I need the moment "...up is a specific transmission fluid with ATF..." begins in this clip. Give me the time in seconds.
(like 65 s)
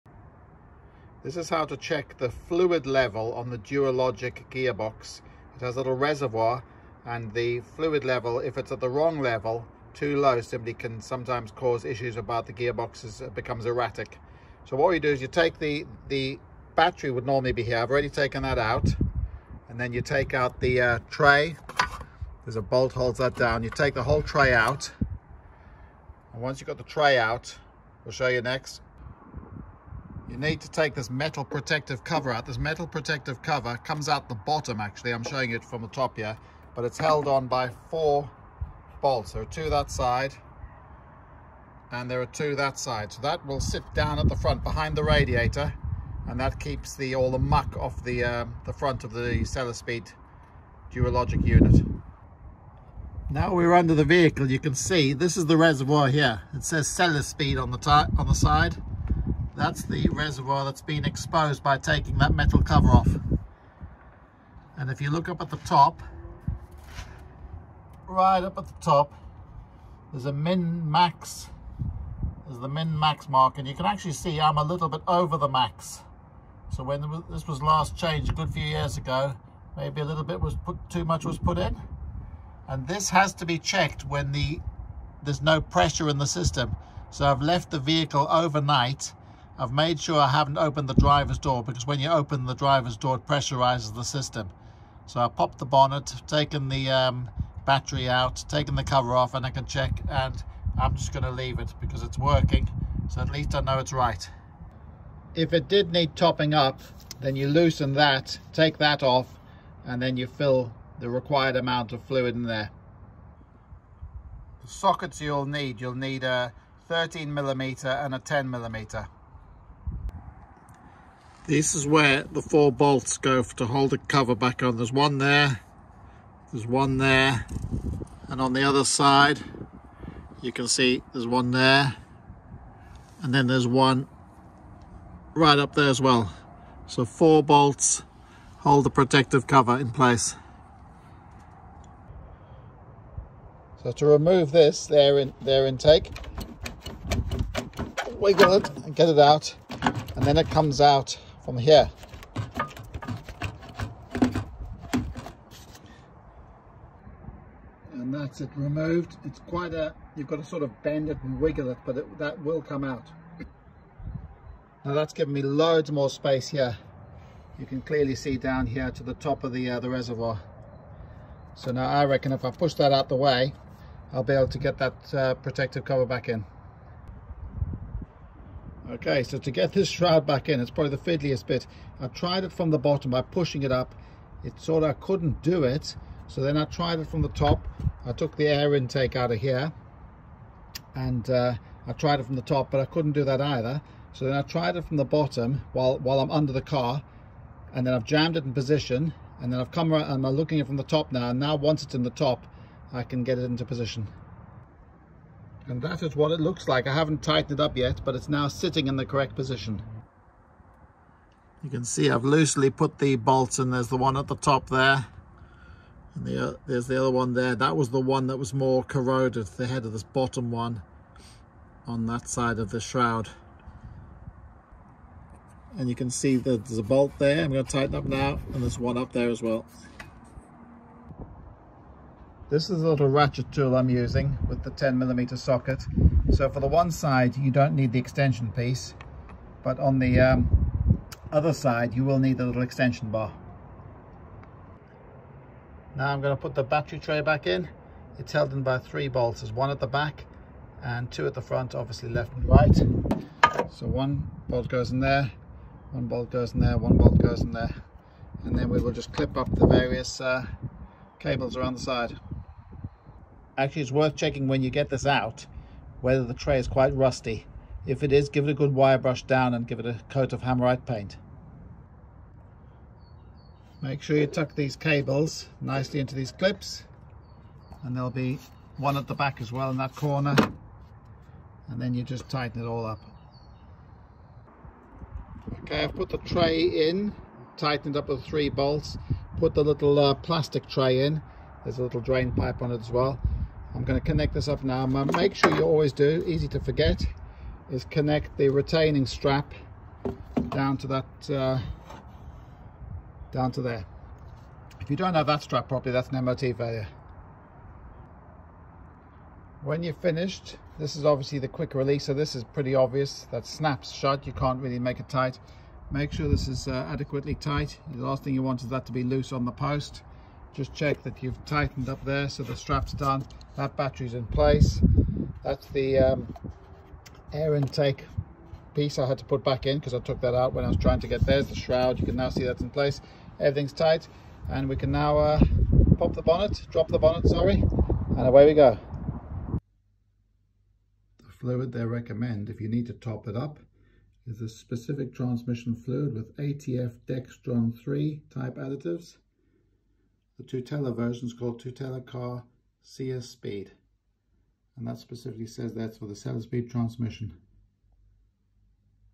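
343 s.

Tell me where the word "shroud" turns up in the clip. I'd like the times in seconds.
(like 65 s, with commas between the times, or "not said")
179 s, 222 s, 331 s.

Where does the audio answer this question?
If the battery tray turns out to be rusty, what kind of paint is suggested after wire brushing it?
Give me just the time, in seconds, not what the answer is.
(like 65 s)
270 s.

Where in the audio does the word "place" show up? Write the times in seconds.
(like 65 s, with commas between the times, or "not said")
139 s, 324 s, 332 s.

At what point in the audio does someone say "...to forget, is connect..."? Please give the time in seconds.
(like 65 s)
296 s.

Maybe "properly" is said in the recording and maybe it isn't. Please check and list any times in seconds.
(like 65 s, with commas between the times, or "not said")
305 s.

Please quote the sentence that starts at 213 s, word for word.
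There's the one at the top there.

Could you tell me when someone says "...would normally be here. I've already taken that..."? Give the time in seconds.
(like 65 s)
17 s.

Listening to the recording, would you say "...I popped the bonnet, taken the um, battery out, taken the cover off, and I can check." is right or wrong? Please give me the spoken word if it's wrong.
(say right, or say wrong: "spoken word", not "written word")
right.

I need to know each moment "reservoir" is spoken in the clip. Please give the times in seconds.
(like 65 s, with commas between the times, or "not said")
5 s, 55 s, 60 s, 169 s.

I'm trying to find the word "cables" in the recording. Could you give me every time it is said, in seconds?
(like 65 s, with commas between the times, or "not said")
261 s, 274 s.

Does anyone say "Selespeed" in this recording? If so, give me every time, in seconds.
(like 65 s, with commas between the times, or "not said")
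56 s, 356 s.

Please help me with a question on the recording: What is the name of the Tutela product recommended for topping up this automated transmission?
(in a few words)
Tutela Car CS Speed.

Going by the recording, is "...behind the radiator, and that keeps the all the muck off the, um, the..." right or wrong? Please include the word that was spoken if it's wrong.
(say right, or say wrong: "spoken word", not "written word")
right.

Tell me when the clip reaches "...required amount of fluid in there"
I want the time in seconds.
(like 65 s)
111 s.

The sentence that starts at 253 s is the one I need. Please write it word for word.
So one bolt goes in there, one bolt goes in there, one bolt goes in there.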